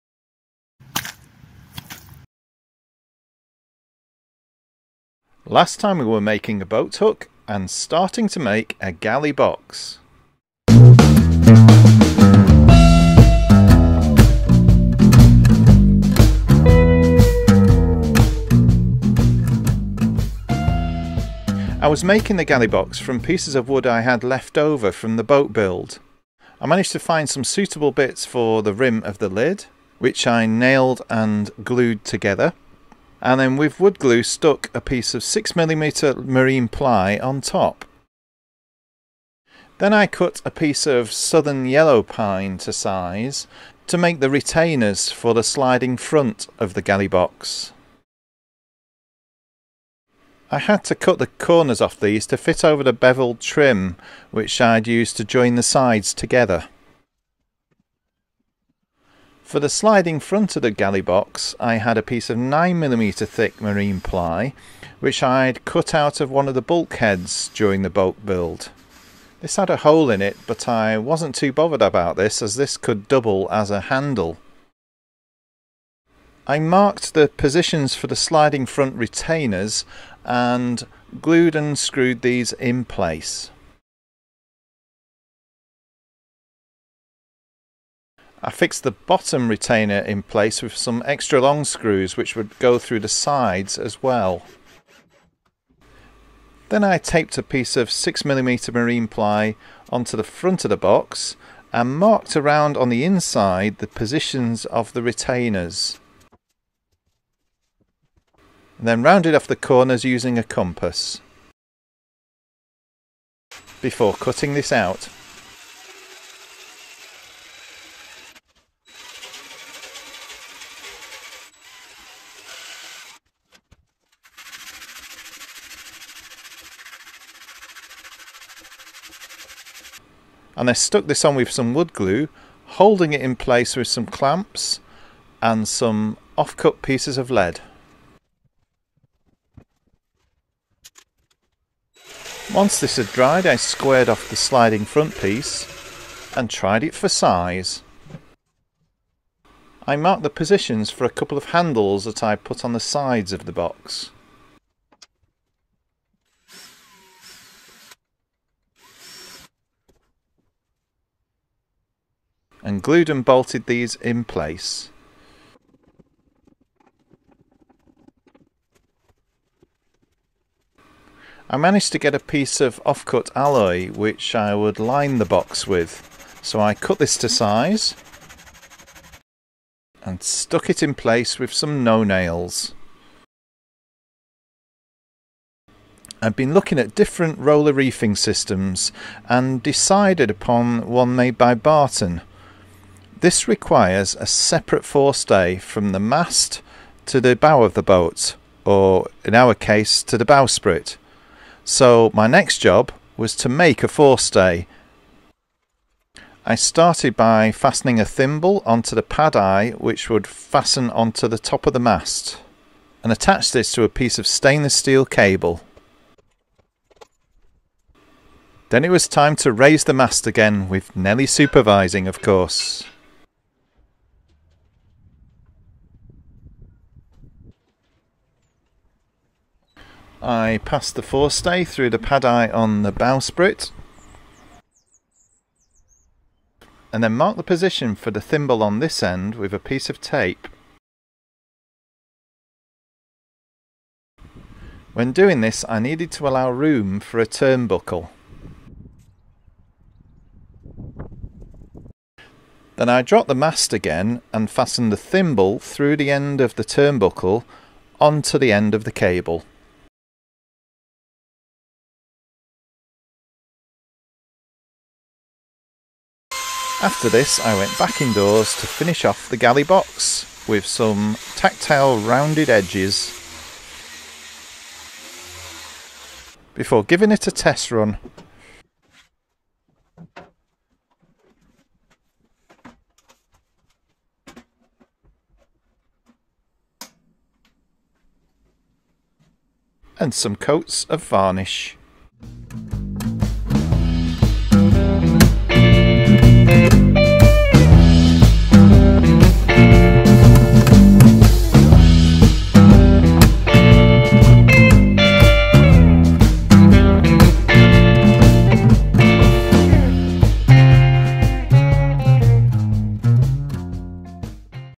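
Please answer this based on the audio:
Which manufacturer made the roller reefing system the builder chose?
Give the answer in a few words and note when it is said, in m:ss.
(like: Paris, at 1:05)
Barton, at 3:11.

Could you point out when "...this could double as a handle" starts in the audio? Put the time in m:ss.
1:12.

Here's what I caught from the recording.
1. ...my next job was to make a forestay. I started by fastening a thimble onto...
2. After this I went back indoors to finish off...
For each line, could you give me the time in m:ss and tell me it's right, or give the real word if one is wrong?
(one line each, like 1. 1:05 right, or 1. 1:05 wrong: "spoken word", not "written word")
1. 3:22 right
2. 4:26 right.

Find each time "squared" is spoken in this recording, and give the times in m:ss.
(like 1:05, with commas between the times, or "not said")
2:23.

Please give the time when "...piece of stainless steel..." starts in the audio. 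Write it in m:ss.
3:33.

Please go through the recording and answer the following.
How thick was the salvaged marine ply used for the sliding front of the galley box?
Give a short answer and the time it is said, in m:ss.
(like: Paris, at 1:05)
9mm, at 1:02.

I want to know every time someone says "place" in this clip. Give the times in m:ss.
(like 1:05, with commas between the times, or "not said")
1:22, 1:30, 2:13, 2:44, 3:00.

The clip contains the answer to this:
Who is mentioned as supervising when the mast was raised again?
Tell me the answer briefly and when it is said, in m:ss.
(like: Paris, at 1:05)
Nelly, at 3:40.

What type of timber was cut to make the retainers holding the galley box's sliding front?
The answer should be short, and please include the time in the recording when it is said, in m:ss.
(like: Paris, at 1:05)
southern yellow pine, at 0:41.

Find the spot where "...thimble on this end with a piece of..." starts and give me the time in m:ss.
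3:58.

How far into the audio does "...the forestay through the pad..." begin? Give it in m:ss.
3:50.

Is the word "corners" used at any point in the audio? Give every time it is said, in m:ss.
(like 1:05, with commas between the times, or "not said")
0:51, 1:49.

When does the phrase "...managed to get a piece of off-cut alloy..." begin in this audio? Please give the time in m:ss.
2:51.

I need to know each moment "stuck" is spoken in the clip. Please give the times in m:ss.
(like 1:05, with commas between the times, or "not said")
0:34, 2:10, 3:00.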